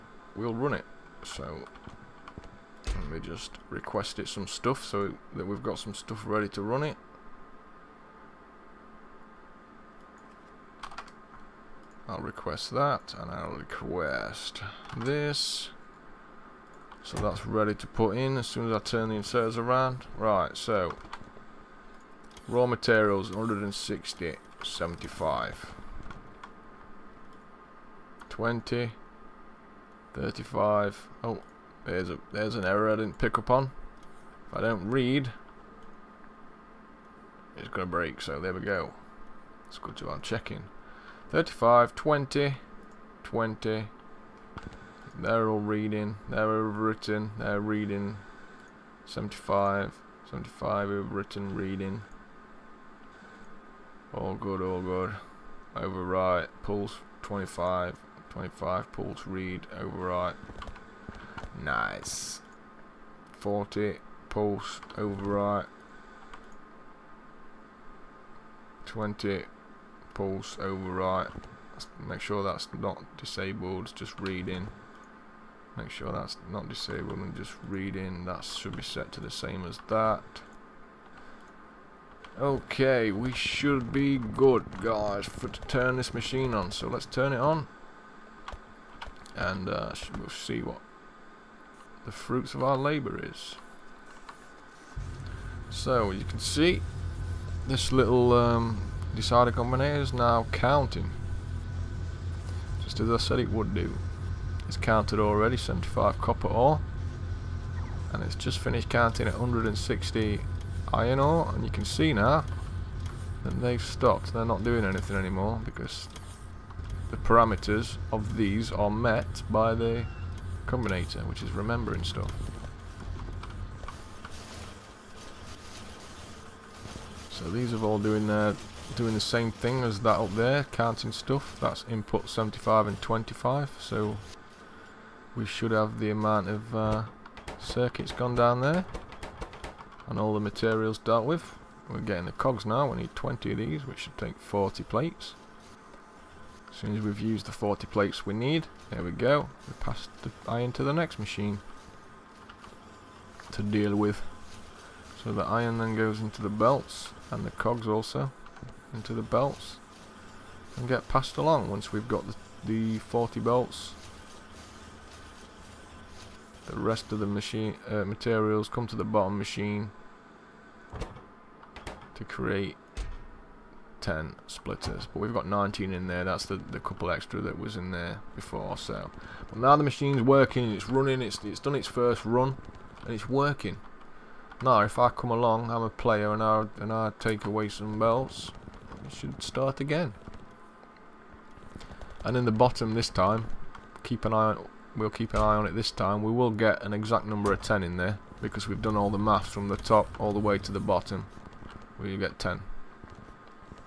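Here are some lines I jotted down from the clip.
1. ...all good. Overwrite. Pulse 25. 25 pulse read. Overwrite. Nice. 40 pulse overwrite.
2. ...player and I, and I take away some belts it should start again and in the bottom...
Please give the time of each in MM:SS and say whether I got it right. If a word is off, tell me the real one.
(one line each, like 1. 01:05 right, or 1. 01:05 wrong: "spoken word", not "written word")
1. 00:54 right
2. 03:05 right.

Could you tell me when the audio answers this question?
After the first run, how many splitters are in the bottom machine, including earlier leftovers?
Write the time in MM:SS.
02:55.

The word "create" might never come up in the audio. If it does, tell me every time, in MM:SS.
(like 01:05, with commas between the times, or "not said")
02:52.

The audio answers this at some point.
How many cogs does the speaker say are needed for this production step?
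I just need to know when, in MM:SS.
02:22.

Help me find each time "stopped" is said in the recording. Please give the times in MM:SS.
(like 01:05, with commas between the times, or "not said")
01:53.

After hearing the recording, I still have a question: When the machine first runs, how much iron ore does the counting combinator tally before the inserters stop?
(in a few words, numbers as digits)
160.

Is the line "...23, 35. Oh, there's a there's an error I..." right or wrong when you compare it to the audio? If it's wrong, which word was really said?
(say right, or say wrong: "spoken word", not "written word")
wrong: "20", not "23".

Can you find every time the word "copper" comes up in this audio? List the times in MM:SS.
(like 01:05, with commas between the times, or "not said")
01:46.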